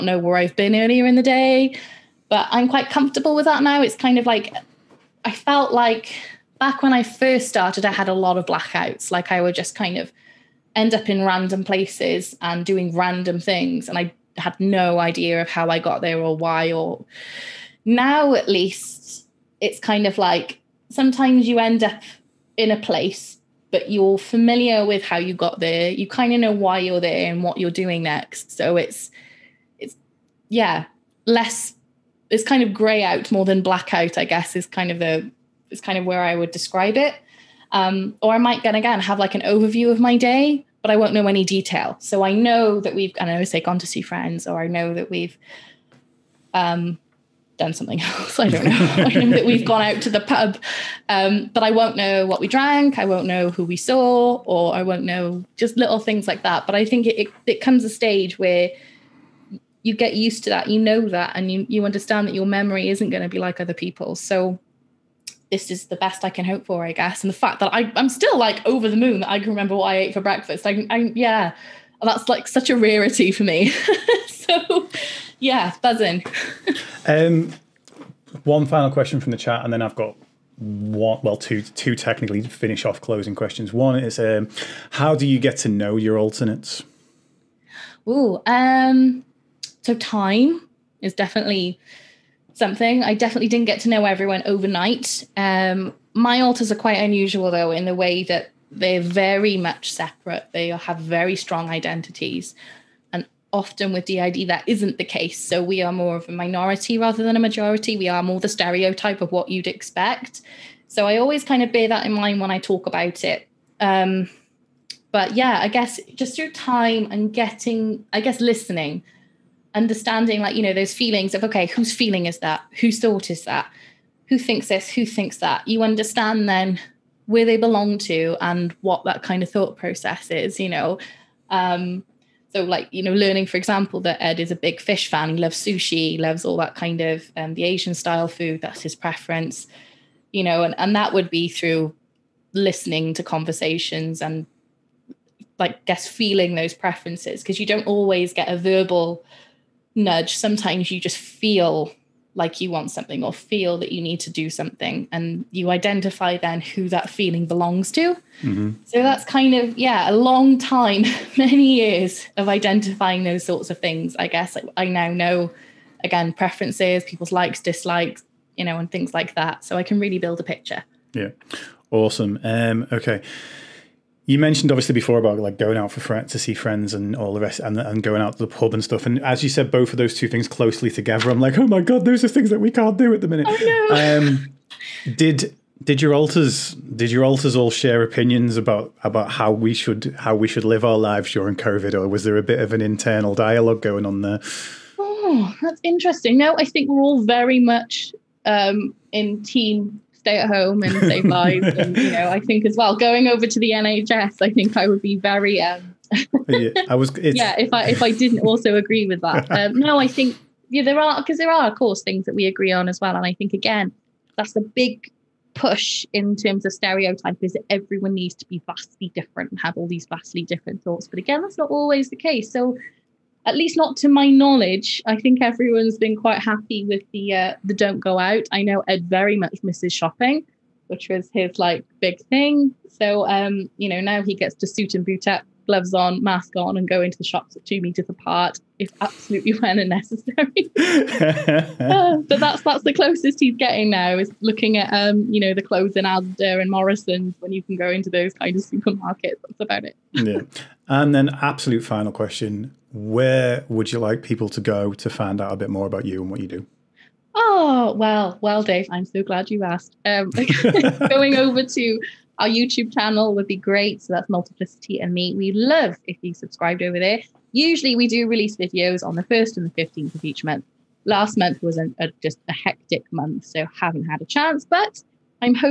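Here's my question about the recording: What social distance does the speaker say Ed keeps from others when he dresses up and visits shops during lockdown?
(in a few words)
2 meters.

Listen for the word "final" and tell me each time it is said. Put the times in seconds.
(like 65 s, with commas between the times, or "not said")
78 s, 251 s.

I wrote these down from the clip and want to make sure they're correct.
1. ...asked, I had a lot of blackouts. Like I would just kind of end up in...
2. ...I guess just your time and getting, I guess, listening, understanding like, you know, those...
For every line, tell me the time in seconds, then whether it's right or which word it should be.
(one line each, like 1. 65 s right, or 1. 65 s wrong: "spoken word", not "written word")
1. 7 s wrong: "started", not "asked"
2. 115 s right.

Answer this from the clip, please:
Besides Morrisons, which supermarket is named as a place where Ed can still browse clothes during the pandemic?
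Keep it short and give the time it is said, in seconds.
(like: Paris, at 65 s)
Asda, at 246 s.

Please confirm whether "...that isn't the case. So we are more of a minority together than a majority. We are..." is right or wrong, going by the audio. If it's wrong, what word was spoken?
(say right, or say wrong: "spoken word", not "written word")
wrong: "rather", not "together".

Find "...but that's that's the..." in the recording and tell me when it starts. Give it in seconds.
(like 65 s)
242 s.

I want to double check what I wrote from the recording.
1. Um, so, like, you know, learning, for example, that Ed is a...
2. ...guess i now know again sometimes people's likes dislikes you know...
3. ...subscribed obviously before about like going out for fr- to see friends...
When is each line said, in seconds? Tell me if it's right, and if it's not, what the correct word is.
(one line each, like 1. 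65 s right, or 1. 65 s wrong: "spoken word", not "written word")
1. 131 s right
2. 164 s wrong: "preferences", not "sometimes"
3. 174 s wrong: "mentioned", not "subscribed".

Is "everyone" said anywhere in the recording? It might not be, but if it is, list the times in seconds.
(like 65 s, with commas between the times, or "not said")
94 s, 217 s, 225 s.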